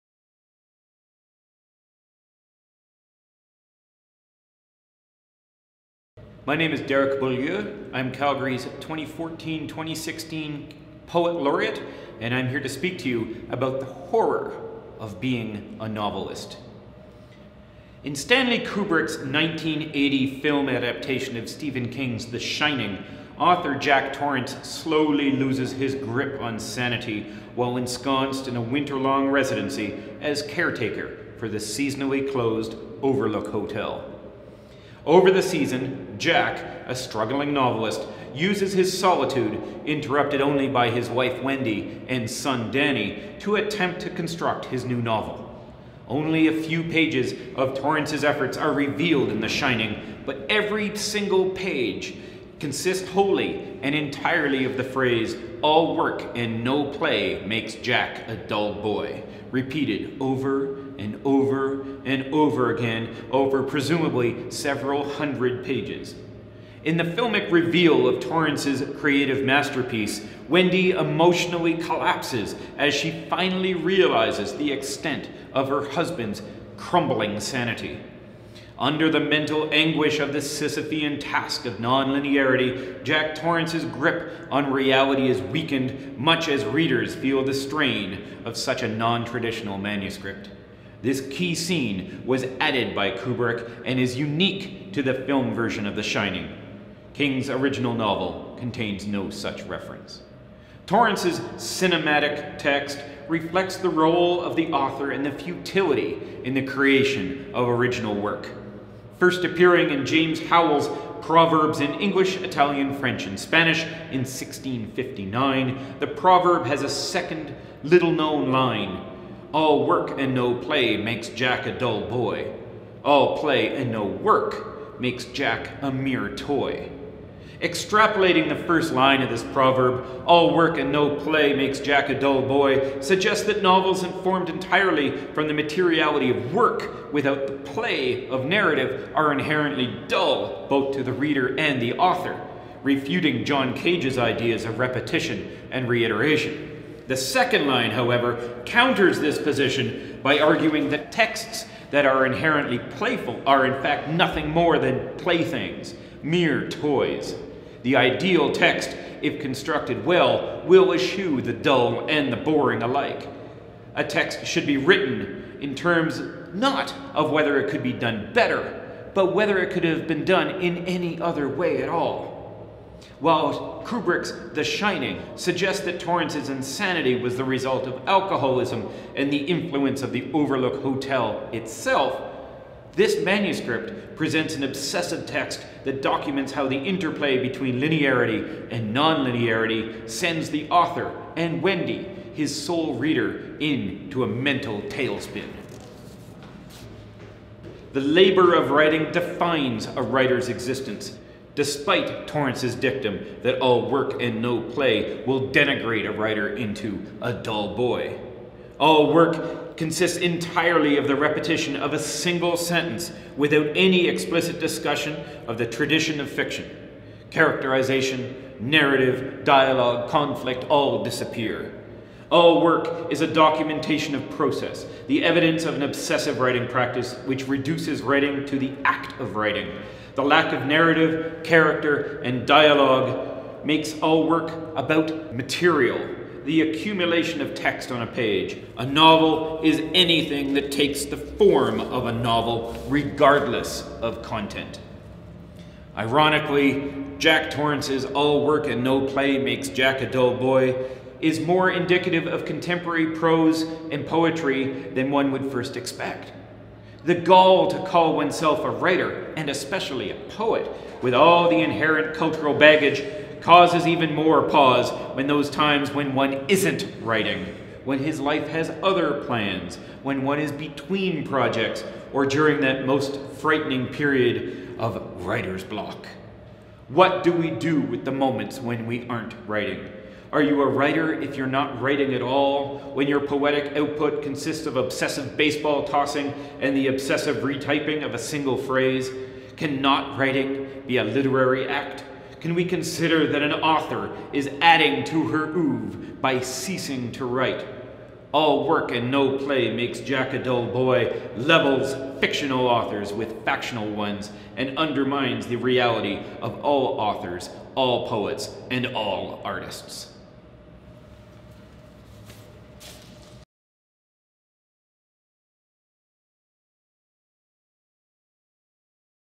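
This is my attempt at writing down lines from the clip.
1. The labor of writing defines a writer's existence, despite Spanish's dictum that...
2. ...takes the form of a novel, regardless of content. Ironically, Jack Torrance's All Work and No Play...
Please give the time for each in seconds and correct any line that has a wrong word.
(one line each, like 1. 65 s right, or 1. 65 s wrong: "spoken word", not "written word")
1. 197 s wrong: "Torrance", not "Spanish"
2. 240 s right.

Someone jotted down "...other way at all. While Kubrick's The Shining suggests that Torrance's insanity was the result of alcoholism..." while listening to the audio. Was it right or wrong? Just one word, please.
right.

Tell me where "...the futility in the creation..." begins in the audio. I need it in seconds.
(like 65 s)
105 s.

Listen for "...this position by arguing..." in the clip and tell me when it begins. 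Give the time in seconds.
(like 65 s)
149 s.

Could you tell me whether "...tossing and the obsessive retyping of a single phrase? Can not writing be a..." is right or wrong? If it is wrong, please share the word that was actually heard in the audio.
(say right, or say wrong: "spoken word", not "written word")
right.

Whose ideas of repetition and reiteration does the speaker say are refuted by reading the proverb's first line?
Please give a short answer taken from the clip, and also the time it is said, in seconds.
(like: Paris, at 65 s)
John Cage, at 143 s.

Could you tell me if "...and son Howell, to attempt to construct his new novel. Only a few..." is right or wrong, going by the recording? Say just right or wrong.
wrong.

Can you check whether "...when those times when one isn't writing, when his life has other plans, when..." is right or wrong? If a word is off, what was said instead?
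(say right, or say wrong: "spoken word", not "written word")
right.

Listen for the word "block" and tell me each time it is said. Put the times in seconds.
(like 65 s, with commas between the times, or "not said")
275 s.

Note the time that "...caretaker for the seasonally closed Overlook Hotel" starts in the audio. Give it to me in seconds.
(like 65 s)
30 s.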